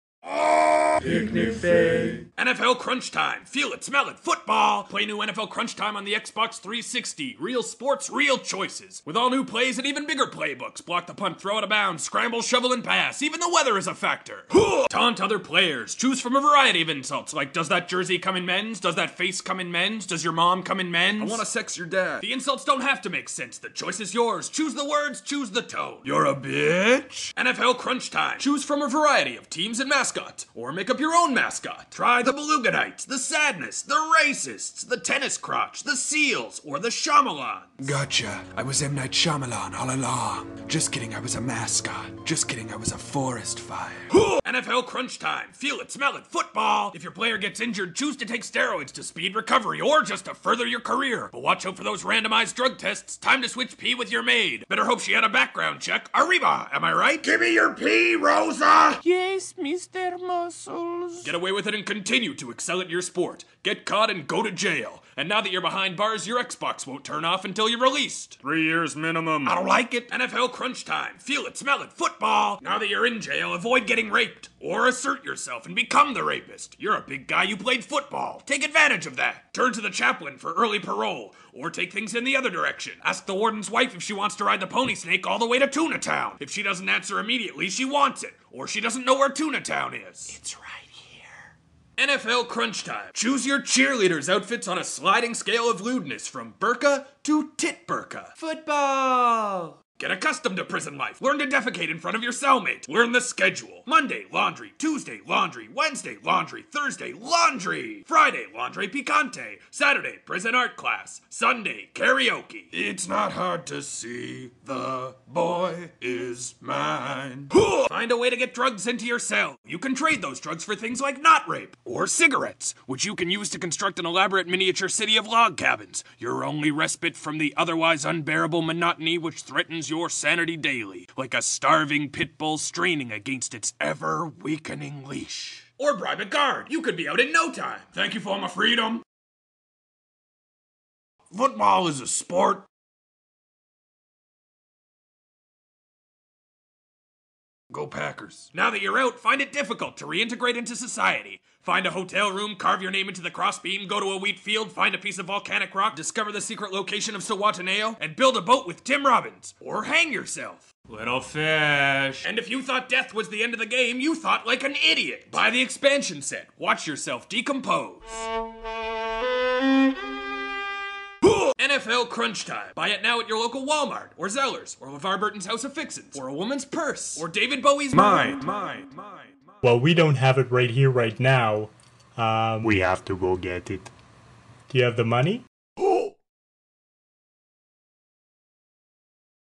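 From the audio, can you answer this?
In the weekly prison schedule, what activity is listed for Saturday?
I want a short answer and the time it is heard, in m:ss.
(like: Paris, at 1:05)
prison art class, at 1:50.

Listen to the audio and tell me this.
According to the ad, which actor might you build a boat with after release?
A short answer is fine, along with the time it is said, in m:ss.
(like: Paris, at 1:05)
Tim Robbins, at 2:38.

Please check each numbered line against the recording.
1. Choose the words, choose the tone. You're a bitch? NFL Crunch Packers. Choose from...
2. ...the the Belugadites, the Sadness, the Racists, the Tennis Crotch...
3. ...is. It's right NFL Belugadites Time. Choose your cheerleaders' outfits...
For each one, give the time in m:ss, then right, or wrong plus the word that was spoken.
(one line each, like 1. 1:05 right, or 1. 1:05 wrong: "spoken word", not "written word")
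1. 0:24 wrong: "Time", not "Packers"
2. 0:32 right
3. 1:29 wrong: "Crunch", not "Belugadites".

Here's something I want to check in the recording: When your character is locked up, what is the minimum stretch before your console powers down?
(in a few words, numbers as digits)
3 years.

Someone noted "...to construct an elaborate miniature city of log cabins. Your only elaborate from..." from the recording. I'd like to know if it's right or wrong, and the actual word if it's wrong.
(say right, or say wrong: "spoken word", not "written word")
wrong: "respite", not "elaborate".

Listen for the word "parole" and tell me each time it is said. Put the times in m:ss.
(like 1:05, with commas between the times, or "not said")
1:20.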